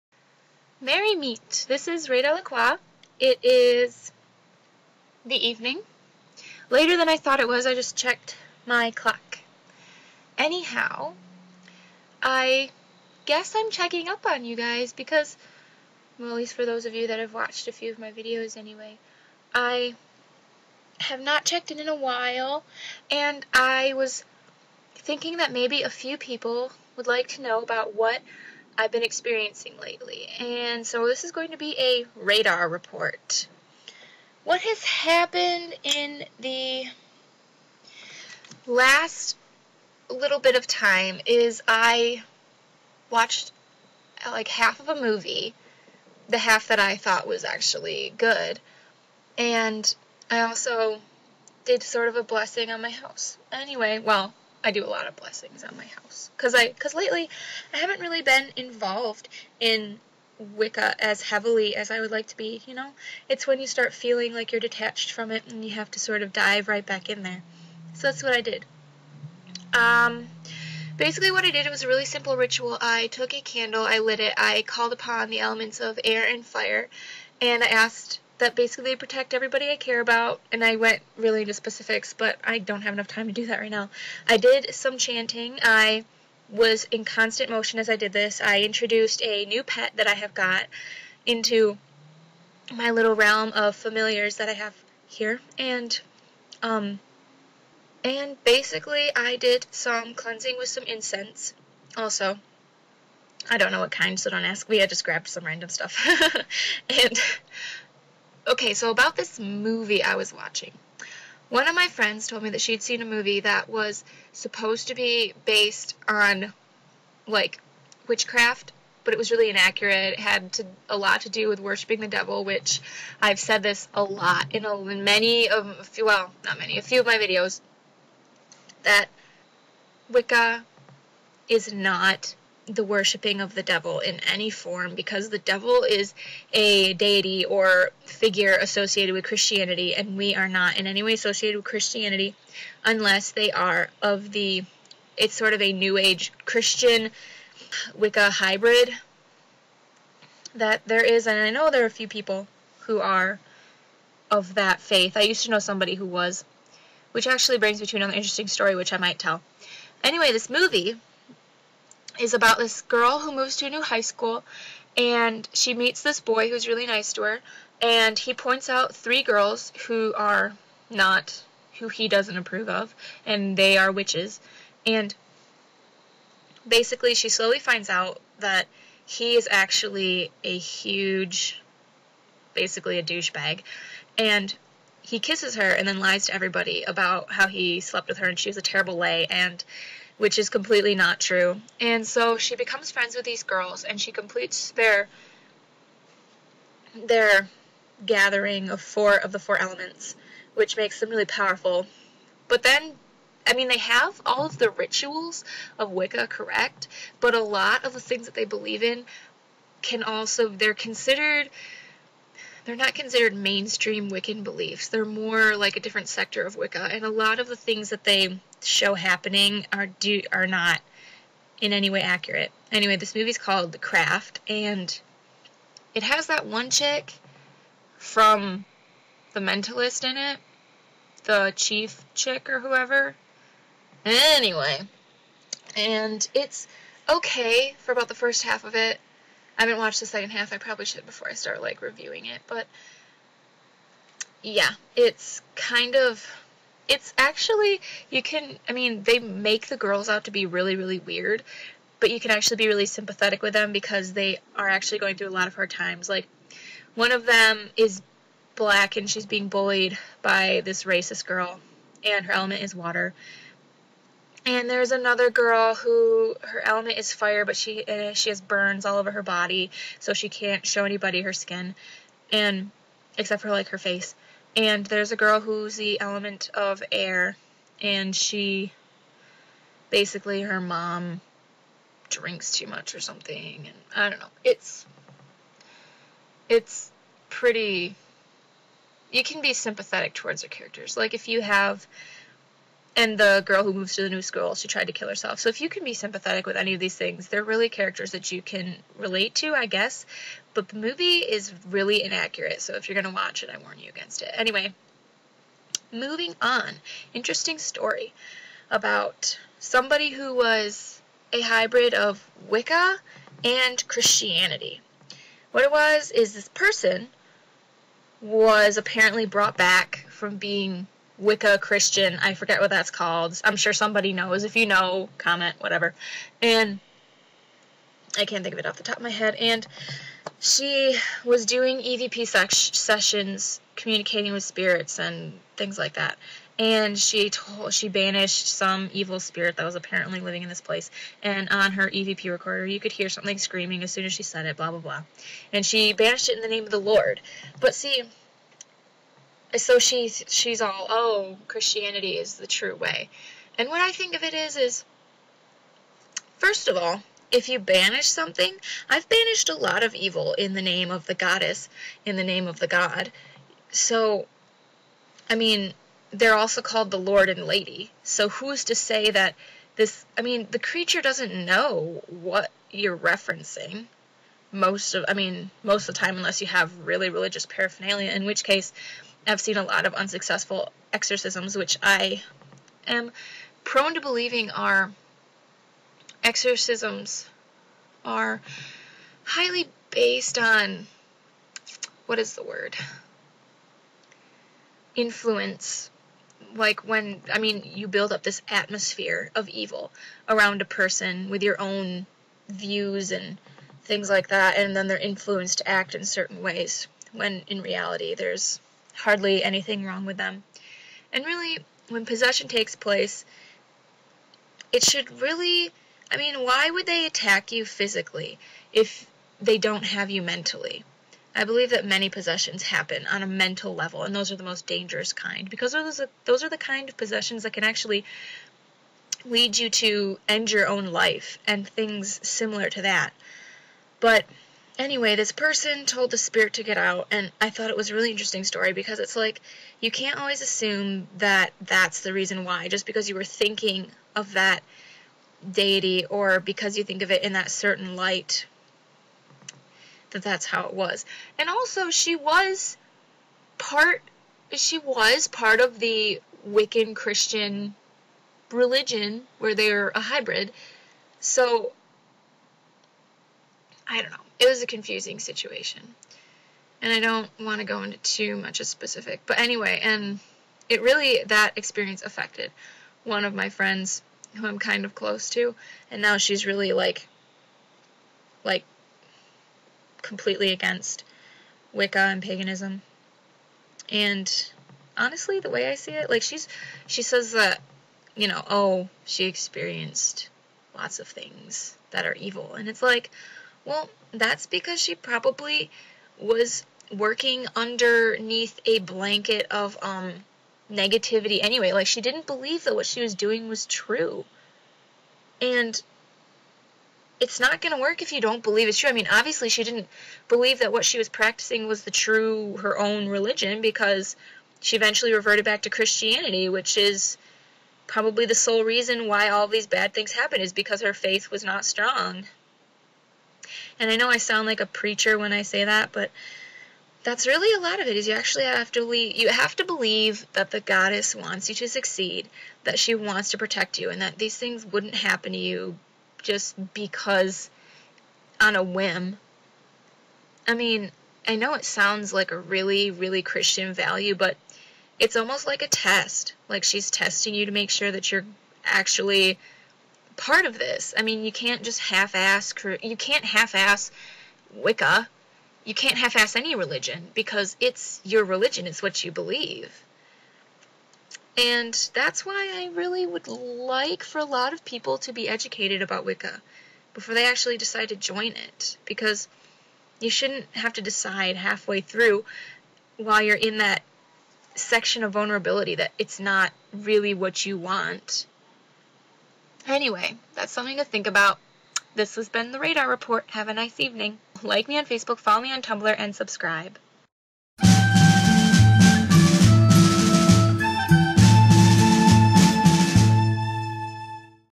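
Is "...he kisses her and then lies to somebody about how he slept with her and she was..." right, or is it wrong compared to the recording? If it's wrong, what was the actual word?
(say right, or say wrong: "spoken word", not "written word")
wrong: "everybody", not "somebody".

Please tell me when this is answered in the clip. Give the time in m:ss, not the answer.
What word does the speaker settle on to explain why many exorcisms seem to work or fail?
6:34.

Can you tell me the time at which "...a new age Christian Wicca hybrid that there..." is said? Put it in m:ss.
2:25.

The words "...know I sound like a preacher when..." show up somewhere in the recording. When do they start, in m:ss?
8:43.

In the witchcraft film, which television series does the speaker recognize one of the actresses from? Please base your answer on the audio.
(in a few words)
The Mentalist.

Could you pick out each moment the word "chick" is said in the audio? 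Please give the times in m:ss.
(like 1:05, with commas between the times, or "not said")
3:46, 3:52.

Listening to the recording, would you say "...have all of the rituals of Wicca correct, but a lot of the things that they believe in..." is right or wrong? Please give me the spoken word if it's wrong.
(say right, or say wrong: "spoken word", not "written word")
right.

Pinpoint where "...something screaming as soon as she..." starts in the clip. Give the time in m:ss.
5:43.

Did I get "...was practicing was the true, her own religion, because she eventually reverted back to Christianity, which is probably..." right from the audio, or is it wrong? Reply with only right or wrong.
right.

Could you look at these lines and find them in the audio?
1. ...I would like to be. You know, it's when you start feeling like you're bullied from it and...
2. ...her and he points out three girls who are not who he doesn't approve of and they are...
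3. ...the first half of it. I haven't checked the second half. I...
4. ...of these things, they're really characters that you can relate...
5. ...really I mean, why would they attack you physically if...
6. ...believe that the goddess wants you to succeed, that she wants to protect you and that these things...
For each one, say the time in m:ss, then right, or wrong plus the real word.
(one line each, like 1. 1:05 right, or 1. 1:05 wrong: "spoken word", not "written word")
1. 1:01 wrong: "detached", not "bullied"
2. 2:47 right
3. 3:58 wrong: "watched", not "checked"
4. 4:56 right
5. 6:55 right
6. 8:49 right.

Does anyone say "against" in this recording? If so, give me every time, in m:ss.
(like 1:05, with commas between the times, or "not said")
5:03, 8:00.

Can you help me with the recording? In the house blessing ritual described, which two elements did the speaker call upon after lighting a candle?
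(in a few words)
air and fire.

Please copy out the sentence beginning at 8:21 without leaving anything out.
Like, she didn't believe that what she was doing was true.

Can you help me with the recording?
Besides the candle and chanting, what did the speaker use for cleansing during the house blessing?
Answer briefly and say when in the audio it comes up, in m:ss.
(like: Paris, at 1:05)
incense, at 1:40.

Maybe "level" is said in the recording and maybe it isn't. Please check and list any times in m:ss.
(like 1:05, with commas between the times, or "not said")
7:03.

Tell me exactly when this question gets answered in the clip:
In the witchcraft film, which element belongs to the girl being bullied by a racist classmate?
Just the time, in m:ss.
4:22.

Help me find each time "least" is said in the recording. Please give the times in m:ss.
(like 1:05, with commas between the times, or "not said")
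0:16.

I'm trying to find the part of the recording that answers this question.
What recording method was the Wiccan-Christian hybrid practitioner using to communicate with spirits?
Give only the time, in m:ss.
5:31.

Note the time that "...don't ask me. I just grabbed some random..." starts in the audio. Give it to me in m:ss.
1:44.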